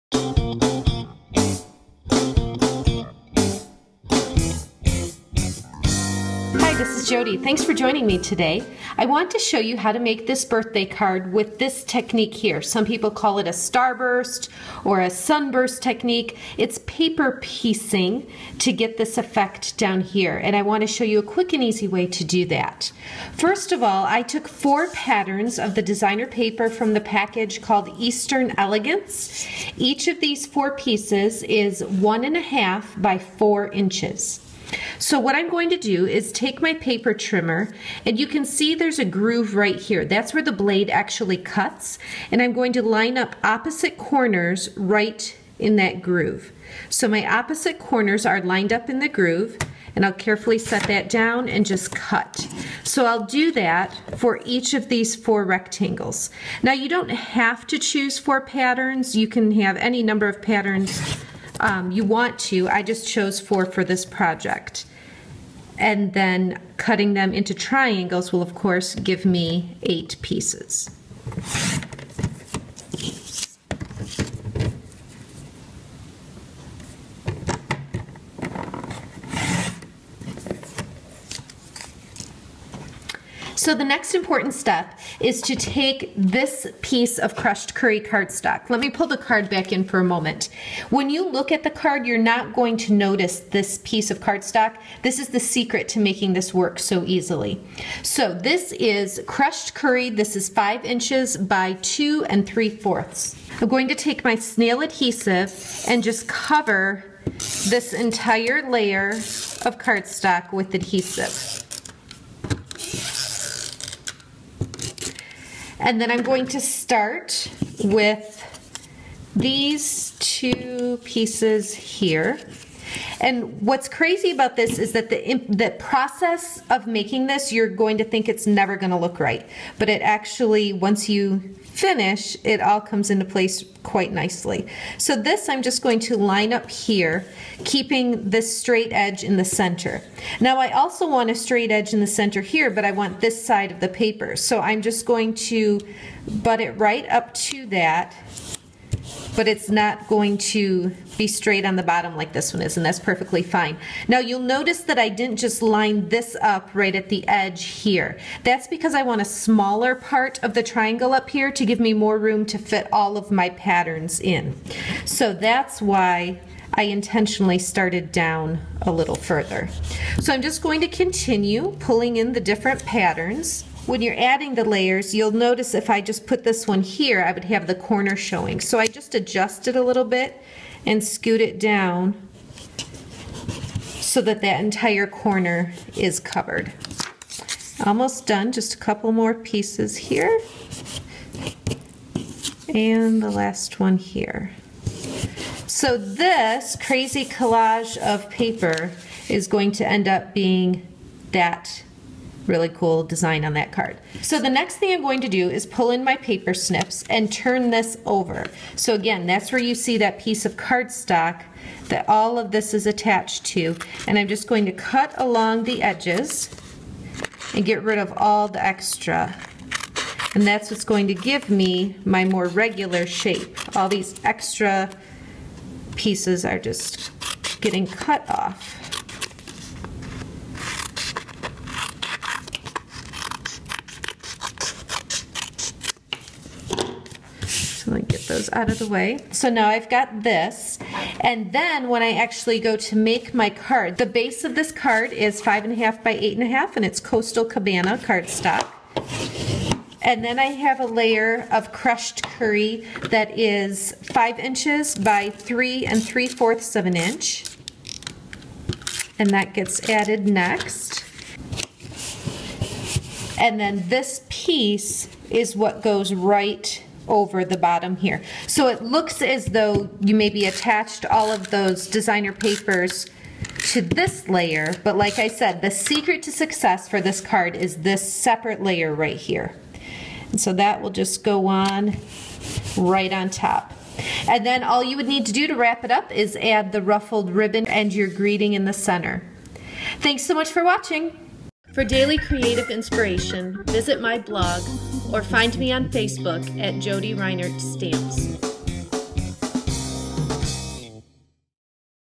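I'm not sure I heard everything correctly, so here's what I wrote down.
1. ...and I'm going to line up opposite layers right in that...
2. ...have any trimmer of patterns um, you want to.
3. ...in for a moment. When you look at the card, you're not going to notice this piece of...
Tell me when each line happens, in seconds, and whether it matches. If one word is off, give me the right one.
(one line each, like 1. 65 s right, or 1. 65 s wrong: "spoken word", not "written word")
1. 42 s wrong: "corners", not "layers"
2. 59 s wrong: "number", not "trimmer"
3. 89 s right.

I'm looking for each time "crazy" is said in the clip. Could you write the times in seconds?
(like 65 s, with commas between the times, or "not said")
123 s, 196 s.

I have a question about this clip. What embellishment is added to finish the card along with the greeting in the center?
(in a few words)
ruffled ribbon.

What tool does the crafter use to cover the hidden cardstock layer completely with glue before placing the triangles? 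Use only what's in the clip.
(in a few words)
snail adhesive.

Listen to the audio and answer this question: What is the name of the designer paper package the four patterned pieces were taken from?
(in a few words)
Eastern Elegance.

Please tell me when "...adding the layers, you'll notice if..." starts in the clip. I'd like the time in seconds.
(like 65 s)
174 s.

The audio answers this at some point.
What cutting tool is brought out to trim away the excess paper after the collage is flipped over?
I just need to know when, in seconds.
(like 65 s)
206 s.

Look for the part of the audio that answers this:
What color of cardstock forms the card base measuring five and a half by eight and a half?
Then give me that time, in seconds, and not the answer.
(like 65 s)
247 s.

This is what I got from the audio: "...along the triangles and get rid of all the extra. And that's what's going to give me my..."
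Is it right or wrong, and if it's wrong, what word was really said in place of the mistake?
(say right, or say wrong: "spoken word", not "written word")
wrong: "edges", not "triangles".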